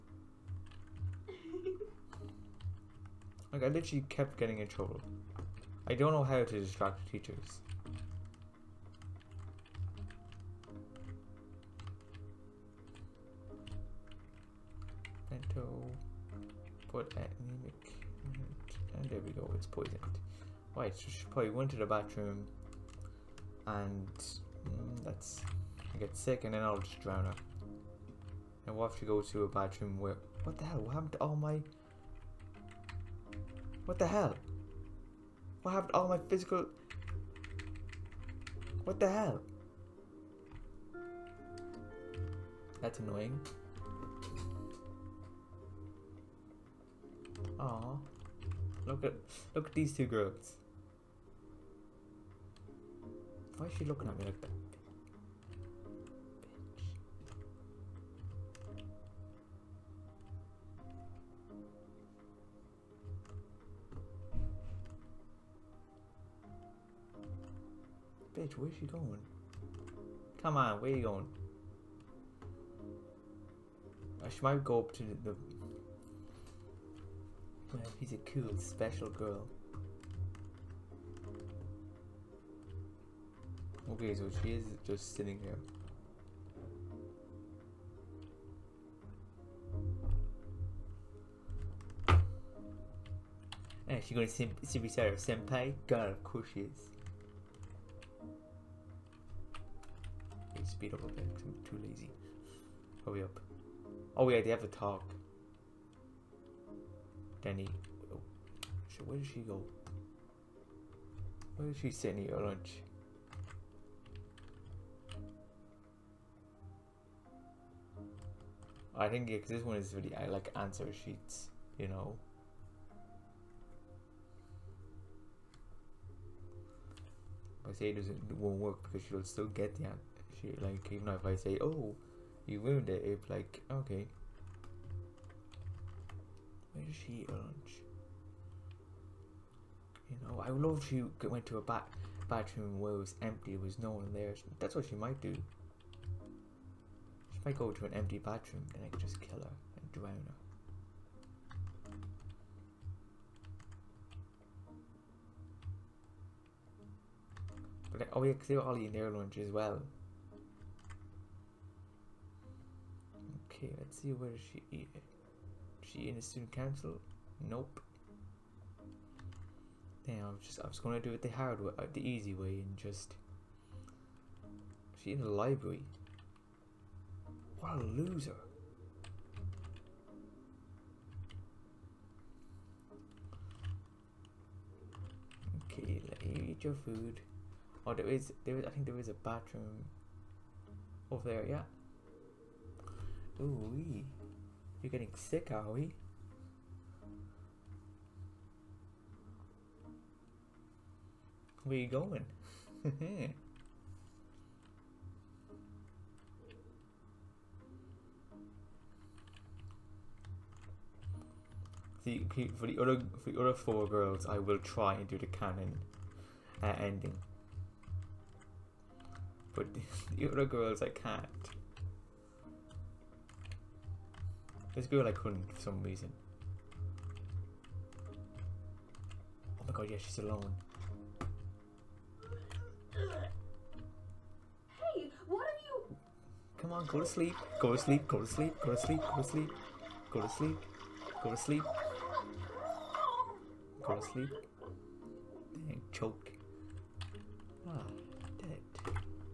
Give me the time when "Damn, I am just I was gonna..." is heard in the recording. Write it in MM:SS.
02:50.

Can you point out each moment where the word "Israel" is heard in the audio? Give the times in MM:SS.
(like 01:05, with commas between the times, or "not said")
not said.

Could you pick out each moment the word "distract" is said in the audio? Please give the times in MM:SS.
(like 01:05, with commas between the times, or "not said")
00:06.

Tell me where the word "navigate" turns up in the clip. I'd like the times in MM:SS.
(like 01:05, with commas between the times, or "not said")
not said.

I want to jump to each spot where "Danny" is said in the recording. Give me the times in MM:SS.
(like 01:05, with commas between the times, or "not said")
01:47.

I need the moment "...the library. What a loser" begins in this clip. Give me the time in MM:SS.
02:55.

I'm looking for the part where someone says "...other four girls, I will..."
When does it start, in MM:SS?
03:33.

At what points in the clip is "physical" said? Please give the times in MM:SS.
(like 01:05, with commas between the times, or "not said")
00:36.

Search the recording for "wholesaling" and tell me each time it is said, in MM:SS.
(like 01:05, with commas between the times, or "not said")
not said.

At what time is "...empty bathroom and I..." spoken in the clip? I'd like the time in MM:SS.
02:27.